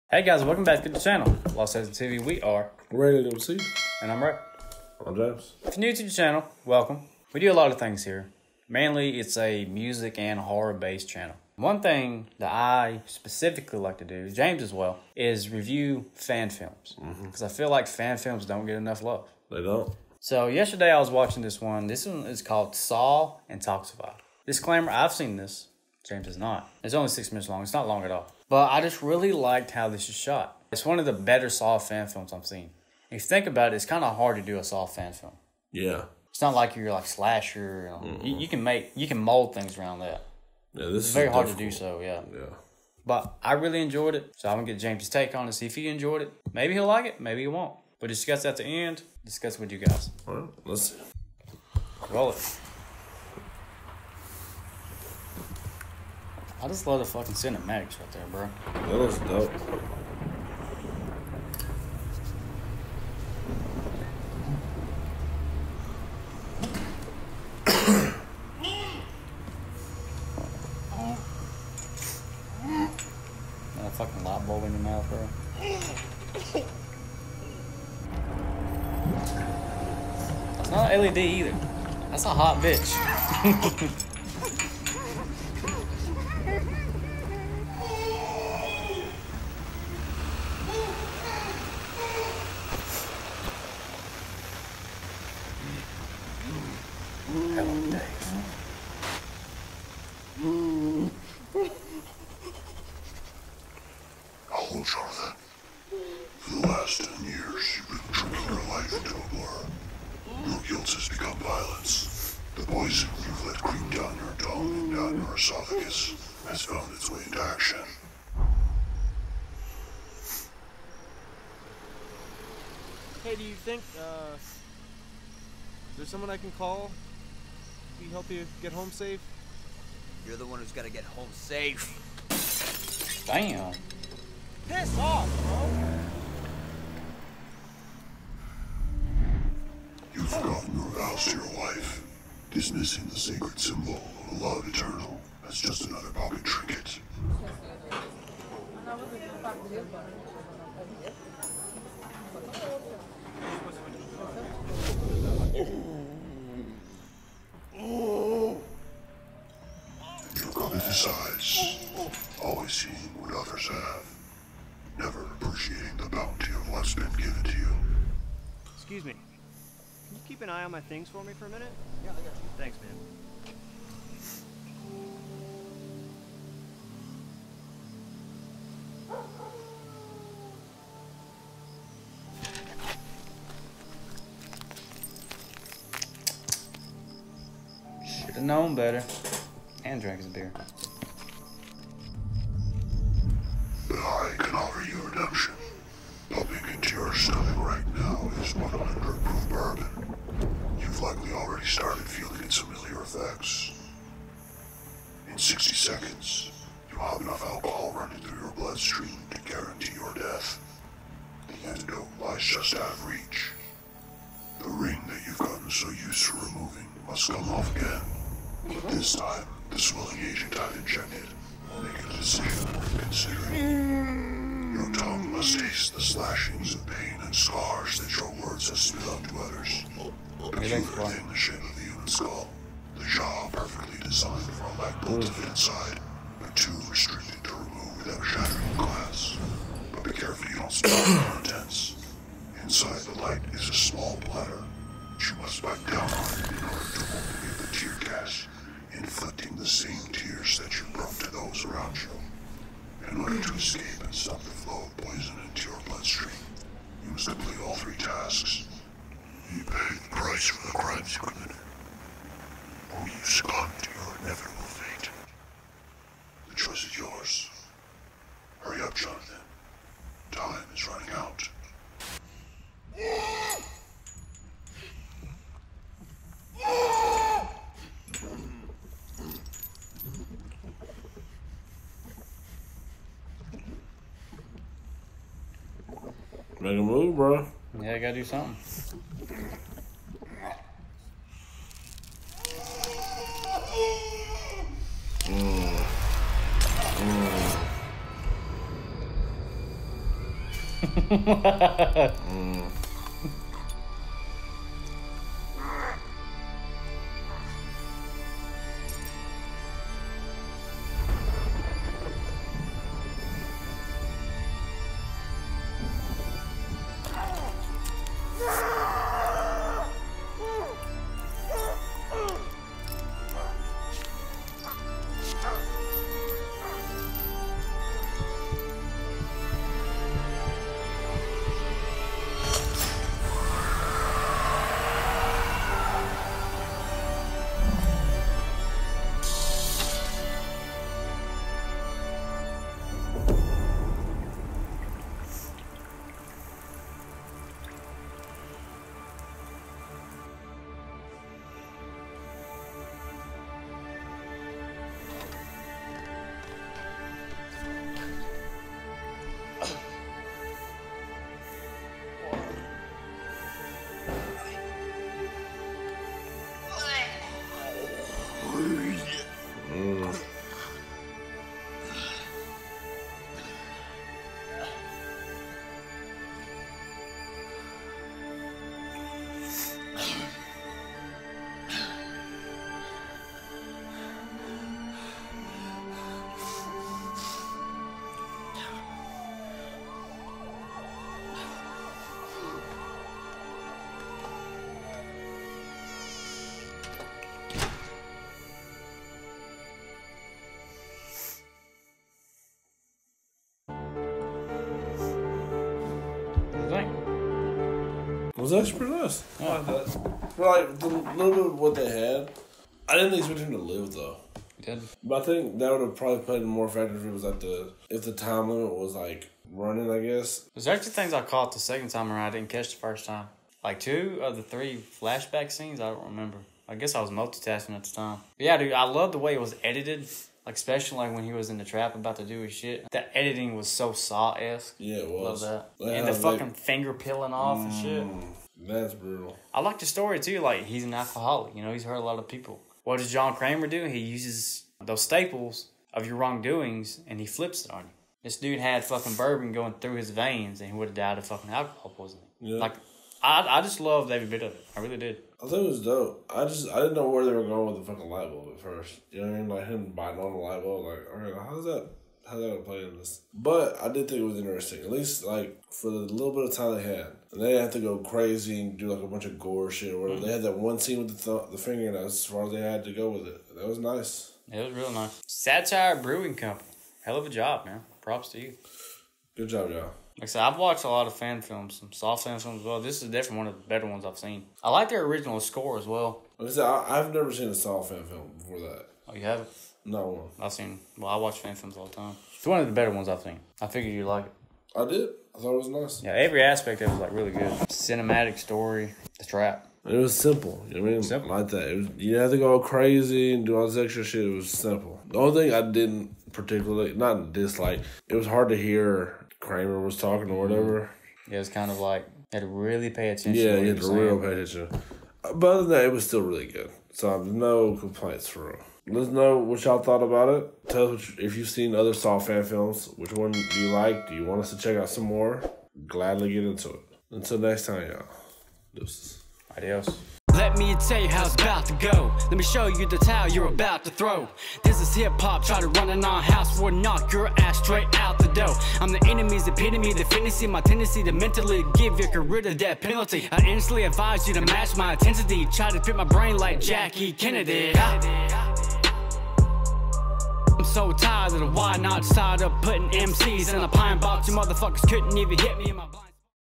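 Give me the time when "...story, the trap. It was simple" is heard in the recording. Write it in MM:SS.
08:18.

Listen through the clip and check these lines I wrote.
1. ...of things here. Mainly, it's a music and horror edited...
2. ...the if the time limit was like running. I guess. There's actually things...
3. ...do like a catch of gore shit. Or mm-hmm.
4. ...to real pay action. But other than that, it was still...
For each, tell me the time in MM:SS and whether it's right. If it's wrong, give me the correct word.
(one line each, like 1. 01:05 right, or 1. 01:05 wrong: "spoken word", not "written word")
1. 00:07 wrong: "based", not "edited"
2. 06:57 right
3. 07:48 wrong: "bunch", not "catch"
4. 08:33 wrong: "attention", not "action".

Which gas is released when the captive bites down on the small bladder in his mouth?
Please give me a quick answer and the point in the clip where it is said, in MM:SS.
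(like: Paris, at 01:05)
tear gas, at 04:07.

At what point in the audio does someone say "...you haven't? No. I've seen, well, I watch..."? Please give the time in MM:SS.
08:09.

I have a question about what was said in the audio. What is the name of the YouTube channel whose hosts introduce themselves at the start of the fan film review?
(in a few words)
Lost Legends TV.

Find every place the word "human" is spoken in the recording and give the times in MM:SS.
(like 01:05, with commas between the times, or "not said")
03:51.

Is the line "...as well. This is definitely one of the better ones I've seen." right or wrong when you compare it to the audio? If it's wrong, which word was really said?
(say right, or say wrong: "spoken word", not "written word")
right.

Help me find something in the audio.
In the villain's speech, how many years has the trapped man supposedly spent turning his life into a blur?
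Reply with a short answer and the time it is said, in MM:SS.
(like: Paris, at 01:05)
10, at 01:47.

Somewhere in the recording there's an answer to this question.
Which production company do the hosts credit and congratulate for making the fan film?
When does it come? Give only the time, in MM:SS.
07:55.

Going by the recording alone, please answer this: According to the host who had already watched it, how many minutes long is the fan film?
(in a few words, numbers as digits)
6.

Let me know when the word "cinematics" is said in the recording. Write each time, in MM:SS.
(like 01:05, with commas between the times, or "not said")
00:57, 08:17.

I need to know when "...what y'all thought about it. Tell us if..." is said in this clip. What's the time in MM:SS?
08:39.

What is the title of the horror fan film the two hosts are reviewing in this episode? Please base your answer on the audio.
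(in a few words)
Saw Intoxify.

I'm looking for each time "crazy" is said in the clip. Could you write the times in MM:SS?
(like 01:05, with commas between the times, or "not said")
07:47, 08:22.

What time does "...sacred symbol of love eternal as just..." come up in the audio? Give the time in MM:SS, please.
02:23.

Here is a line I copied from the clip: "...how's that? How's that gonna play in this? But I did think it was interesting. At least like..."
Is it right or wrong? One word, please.
right.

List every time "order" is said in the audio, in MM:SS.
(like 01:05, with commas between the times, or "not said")
04:06, 04:13.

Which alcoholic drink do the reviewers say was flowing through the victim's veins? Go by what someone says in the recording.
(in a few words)
bourbon.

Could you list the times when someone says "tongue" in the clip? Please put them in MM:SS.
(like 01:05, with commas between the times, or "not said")
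01:54, 03:44.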